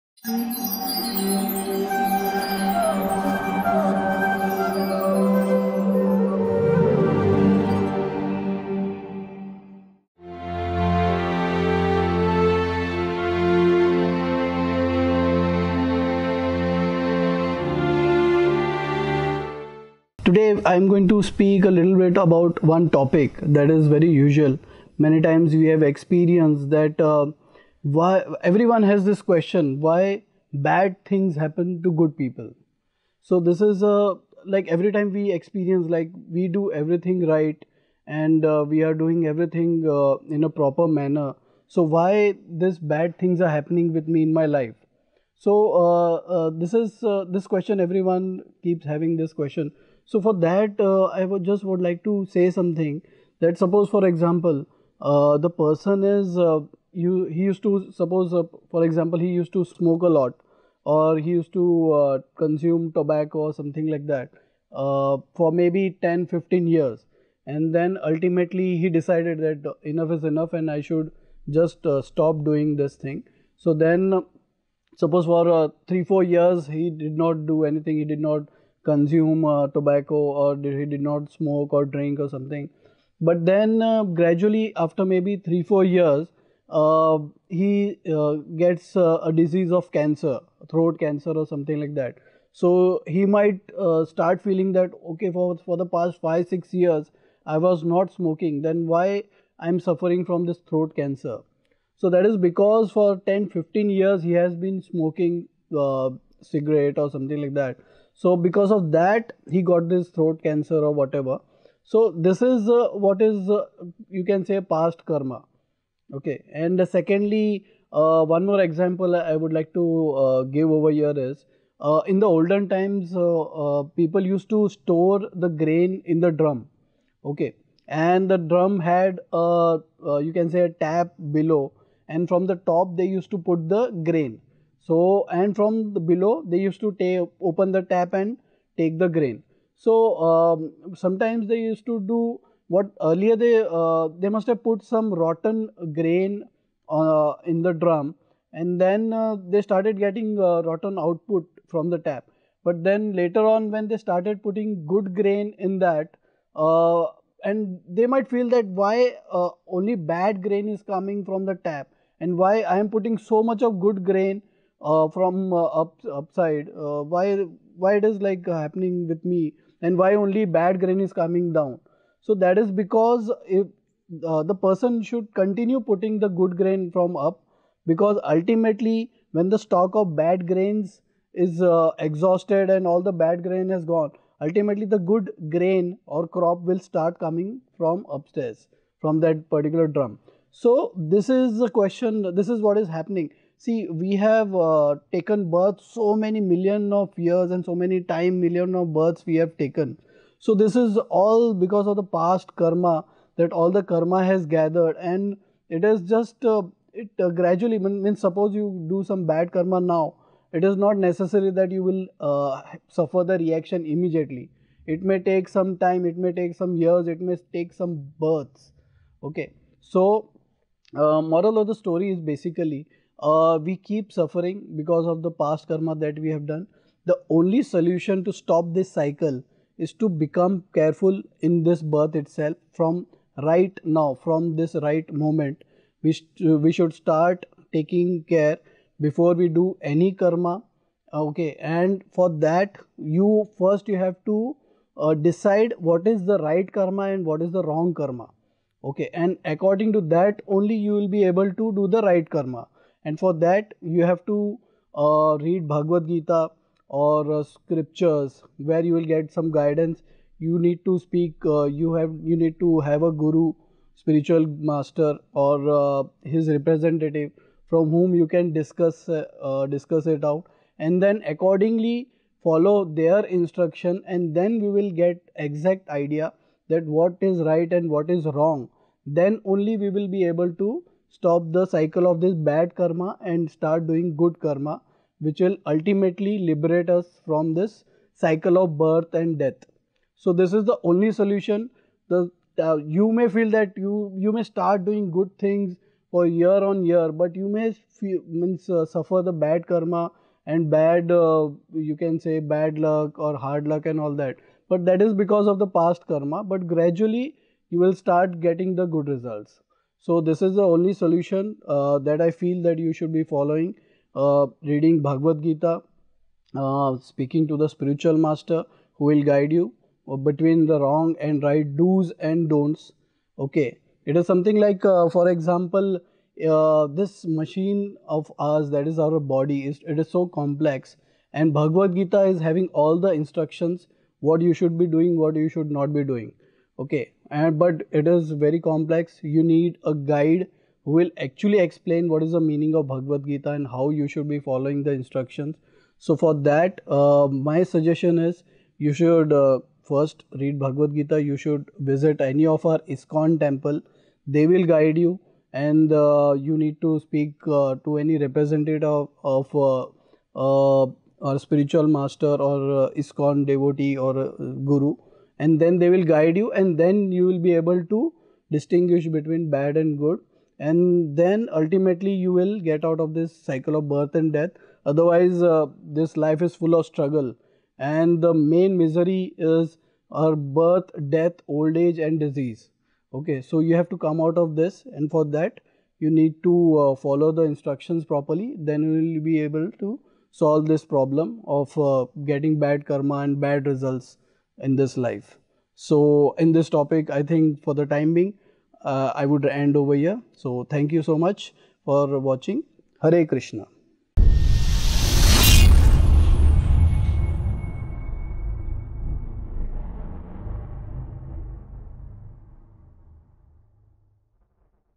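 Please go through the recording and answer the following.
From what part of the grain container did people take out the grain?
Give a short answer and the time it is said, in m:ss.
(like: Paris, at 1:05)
A tap, at 2:10.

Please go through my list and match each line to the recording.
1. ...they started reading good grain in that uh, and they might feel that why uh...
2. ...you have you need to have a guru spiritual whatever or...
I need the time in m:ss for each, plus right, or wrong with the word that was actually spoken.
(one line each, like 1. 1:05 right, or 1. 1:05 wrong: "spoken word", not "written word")
1. 2:33 wrong: "putting", not "reading"
2. 4:21 wrong: "master", not "whatever".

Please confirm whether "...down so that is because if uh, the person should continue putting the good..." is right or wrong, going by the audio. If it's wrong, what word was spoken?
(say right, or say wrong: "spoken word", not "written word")
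right.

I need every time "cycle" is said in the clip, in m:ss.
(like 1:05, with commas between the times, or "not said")
3:48, 4:41, 4:48, 6:13.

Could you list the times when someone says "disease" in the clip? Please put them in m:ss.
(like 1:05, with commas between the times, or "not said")
1:29, 6:22.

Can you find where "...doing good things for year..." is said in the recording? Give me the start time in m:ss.
4:54.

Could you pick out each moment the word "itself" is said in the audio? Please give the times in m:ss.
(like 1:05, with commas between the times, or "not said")
3:52.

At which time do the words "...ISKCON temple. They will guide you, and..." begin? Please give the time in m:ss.
5:52.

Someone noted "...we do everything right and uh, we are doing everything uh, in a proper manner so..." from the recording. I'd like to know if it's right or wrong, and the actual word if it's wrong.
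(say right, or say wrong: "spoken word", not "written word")
right.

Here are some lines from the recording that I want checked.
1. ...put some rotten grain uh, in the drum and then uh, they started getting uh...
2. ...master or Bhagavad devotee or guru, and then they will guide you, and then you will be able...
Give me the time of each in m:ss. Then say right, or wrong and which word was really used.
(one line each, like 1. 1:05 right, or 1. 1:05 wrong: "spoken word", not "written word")
1. 2:24 right
2. 6:01 wrong: "ISKCON", not "Bhagavad".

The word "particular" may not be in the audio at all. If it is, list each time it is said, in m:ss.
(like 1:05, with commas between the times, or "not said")
3:09.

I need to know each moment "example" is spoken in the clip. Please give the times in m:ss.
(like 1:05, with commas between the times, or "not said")
0:54, 0:58, 1:58, 5:25.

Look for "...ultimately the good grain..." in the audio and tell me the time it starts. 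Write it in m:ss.
3:04.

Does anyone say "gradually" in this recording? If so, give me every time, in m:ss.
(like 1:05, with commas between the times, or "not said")
1:24, 3:27, 5:06.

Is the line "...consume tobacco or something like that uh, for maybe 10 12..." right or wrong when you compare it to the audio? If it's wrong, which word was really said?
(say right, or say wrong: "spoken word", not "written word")
wrong: "15", not "12".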